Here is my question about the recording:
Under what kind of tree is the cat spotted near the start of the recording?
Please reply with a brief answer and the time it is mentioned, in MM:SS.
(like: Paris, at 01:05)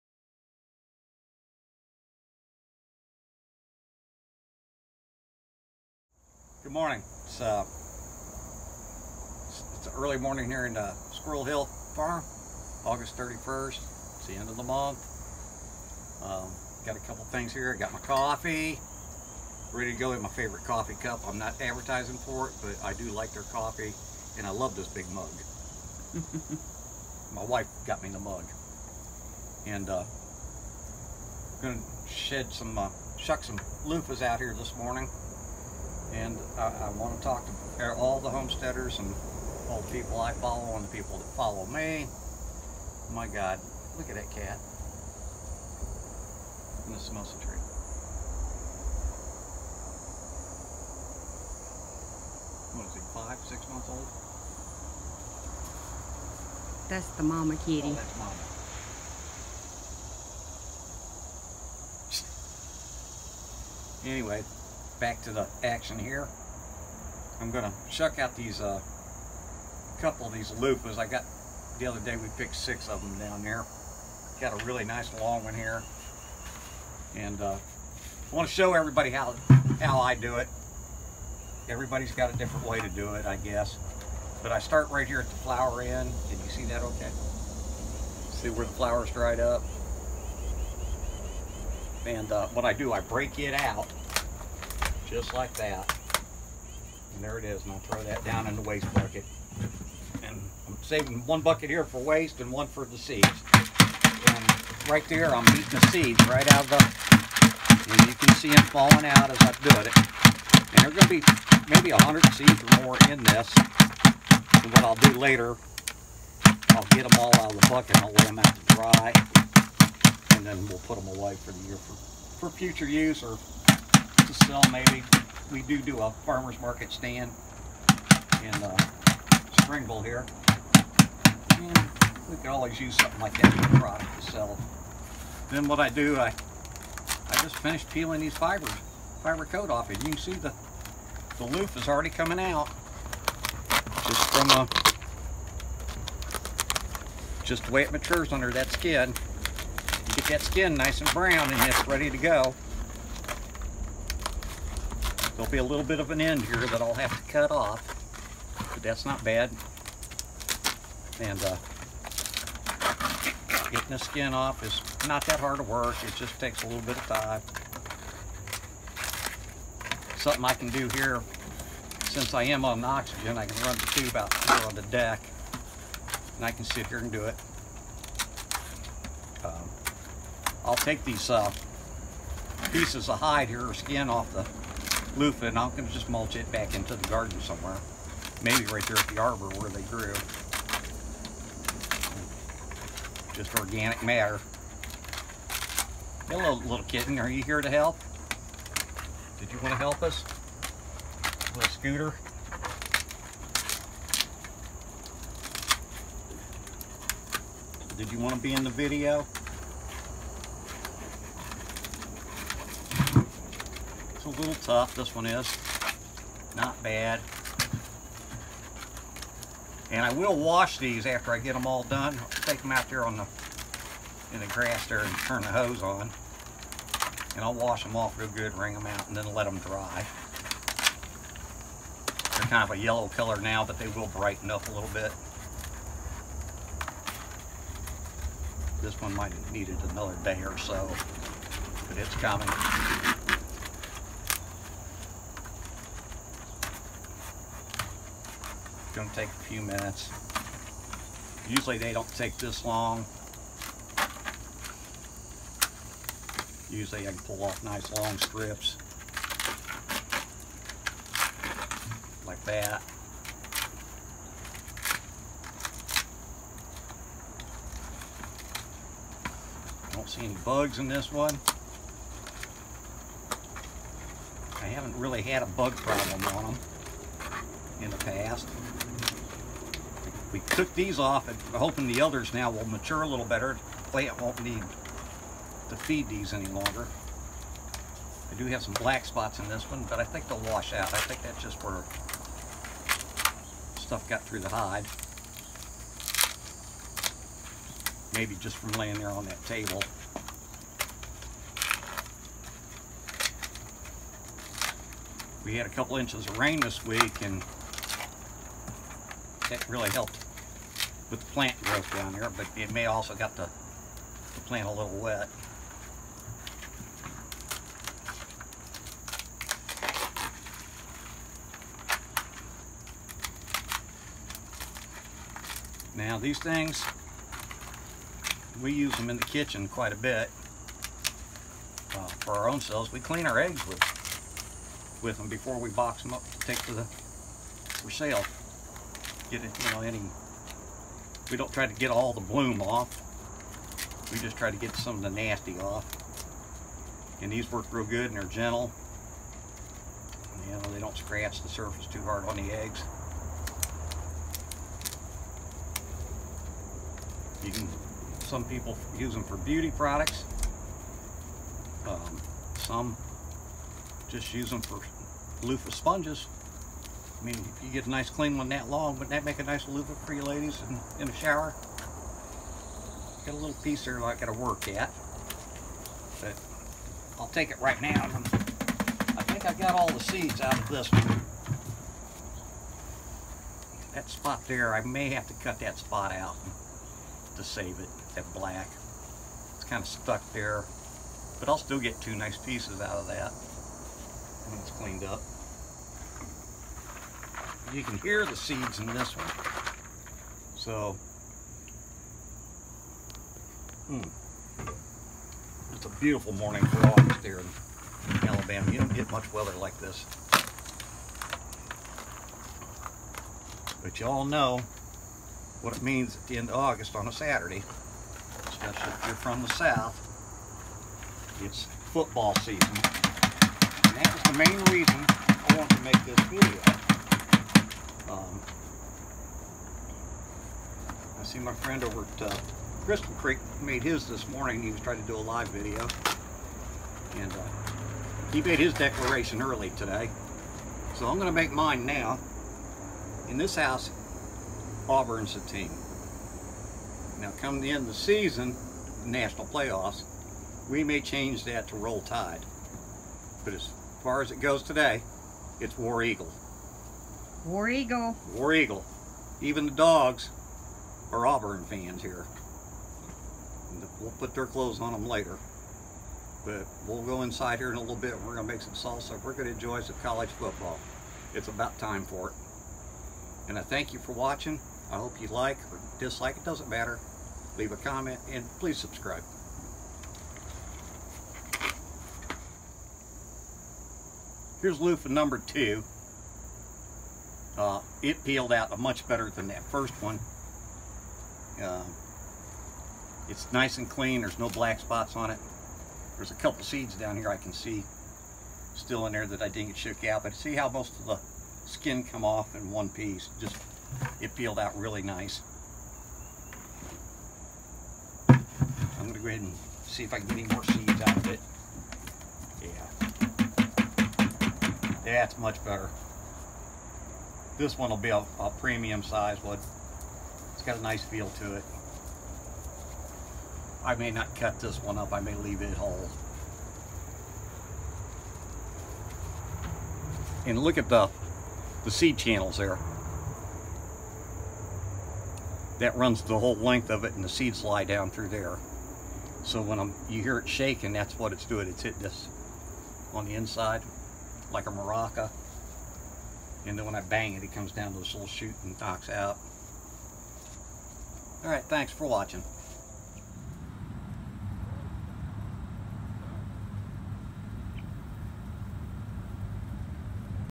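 mimosa, at 00:47.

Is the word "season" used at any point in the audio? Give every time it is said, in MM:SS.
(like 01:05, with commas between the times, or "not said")
07:02, 07:27.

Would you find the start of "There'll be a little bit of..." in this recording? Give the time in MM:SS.
02:35.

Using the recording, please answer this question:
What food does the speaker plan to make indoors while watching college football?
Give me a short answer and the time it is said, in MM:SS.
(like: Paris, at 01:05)
salsa, at 07:48.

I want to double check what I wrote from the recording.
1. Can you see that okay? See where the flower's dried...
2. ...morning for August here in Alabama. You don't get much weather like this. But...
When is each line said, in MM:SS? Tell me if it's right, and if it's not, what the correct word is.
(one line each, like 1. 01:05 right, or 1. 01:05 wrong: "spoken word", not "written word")
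1. 01:26 right
2. 06:46 right.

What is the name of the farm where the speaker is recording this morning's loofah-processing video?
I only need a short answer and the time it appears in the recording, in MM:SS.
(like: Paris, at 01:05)
Squirrel Hill Farm, at 00:11.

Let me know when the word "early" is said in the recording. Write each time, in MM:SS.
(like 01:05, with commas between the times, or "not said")
00:10, 07:19.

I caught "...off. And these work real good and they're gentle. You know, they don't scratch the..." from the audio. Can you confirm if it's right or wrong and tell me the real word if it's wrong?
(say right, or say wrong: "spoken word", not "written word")
right.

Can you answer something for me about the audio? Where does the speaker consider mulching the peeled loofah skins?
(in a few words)
the arbor.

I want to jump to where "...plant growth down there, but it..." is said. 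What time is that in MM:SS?
05:11.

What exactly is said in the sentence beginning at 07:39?
Even the dogs are Auburn fans here.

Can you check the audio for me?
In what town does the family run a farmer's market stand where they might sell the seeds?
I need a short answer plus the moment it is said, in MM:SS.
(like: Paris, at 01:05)
Springville, at 02:09.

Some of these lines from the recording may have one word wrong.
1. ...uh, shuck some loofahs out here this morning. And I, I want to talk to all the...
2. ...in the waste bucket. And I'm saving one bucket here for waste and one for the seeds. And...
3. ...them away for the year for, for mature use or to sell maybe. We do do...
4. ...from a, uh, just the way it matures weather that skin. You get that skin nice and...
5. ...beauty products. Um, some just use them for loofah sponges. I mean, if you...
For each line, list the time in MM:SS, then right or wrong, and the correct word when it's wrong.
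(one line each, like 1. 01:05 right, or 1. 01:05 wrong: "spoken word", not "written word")
1. 00:32 right
2. 01:38 right
3. 02:00 wrong: "future", not "mature"
4. 02:24 wrong: "under", not "weather"
5. 05:59 right.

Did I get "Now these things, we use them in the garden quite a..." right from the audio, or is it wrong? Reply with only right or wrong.
wrong.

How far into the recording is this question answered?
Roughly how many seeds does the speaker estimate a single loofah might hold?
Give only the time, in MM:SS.
01:51.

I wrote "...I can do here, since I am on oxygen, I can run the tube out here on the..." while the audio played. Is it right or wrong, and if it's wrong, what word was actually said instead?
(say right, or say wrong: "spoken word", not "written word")
right.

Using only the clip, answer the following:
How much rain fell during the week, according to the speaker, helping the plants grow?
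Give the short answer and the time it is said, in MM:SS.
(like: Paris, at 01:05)
a couple inches, at 05:05.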